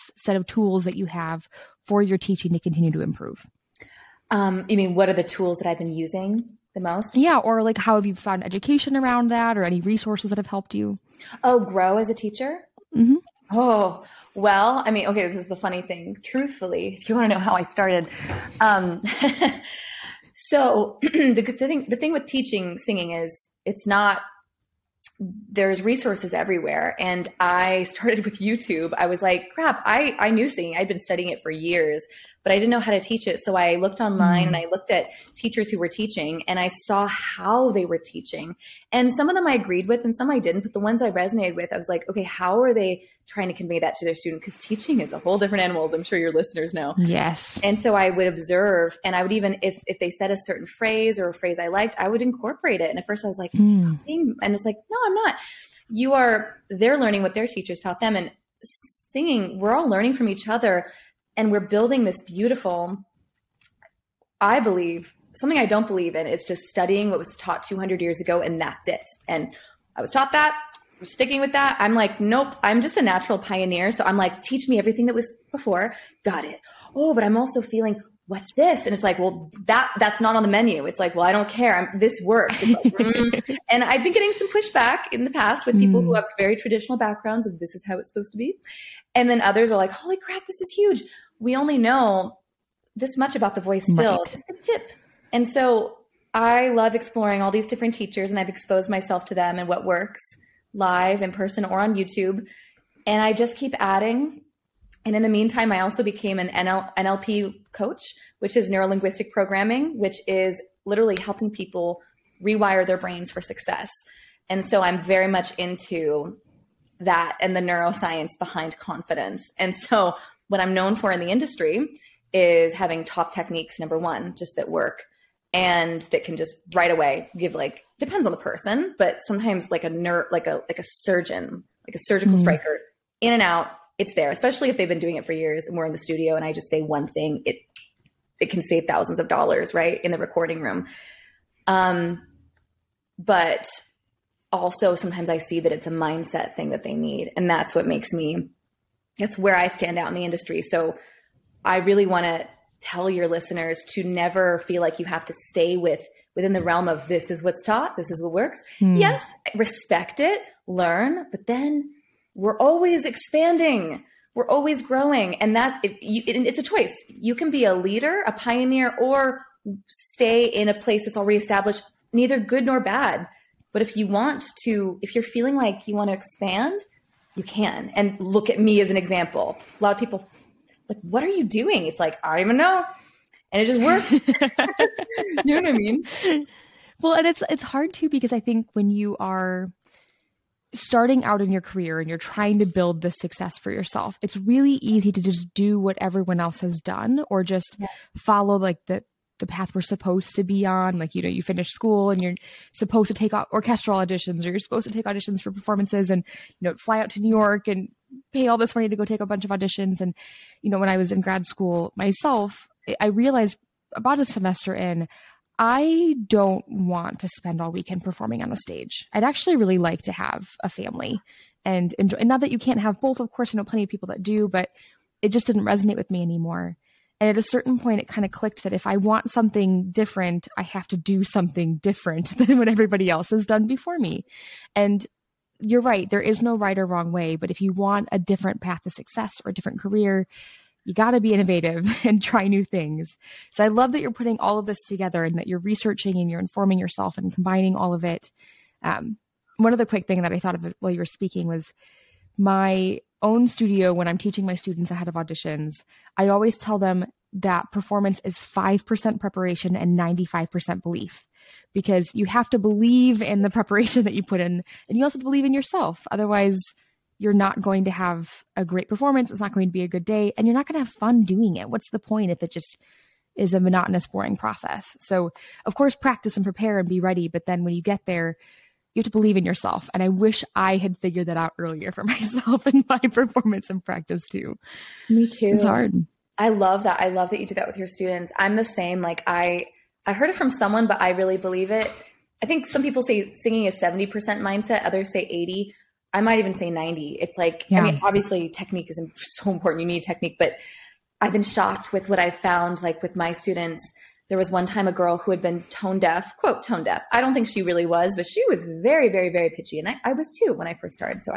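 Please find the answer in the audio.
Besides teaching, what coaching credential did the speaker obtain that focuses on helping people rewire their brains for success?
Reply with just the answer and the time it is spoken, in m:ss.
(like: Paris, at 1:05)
NLP coach, at 1:46.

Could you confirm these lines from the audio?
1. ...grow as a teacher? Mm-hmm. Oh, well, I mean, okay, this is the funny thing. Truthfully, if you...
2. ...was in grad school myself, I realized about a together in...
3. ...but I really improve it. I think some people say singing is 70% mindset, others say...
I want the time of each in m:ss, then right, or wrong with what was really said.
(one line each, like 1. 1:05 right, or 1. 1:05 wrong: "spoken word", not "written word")
1. 0:11 right
2. 3:30 wrong: "semester", not "together"
3. 4:50 wrong: "believe", not "improve".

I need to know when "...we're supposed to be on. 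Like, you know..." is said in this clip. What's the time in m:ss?
3:19.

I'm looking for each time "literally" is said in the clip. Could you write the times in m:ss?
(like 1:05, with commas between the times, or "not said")
1:50.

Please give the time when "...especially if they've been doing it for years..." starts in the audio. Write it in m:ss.
2:14.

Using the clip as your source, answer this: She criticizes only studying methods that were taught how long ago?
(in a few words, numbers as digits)
200 years ago.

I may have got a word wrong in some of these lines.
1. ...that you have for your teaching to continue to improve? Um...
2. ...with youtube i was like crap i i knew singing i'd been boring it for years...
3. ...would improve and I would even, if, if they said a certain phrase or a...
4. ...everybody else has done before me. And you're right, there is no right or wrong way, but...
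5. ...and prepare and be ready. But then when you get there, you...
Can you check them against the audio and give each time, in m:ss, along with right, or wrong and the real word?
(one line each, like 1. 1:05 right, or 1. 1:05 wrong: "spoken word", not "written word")
1. 0:00 right
2. 0:28 wrong: "studying", not "boring"
3. 0:48 wrong: "observe", not "improve"
4. 3:52 right
5. 4:36 right.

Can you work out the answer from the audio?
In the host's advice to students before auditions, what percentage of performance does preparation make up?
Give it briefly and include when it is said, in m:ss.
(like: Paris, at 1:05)
5%, at 4:18.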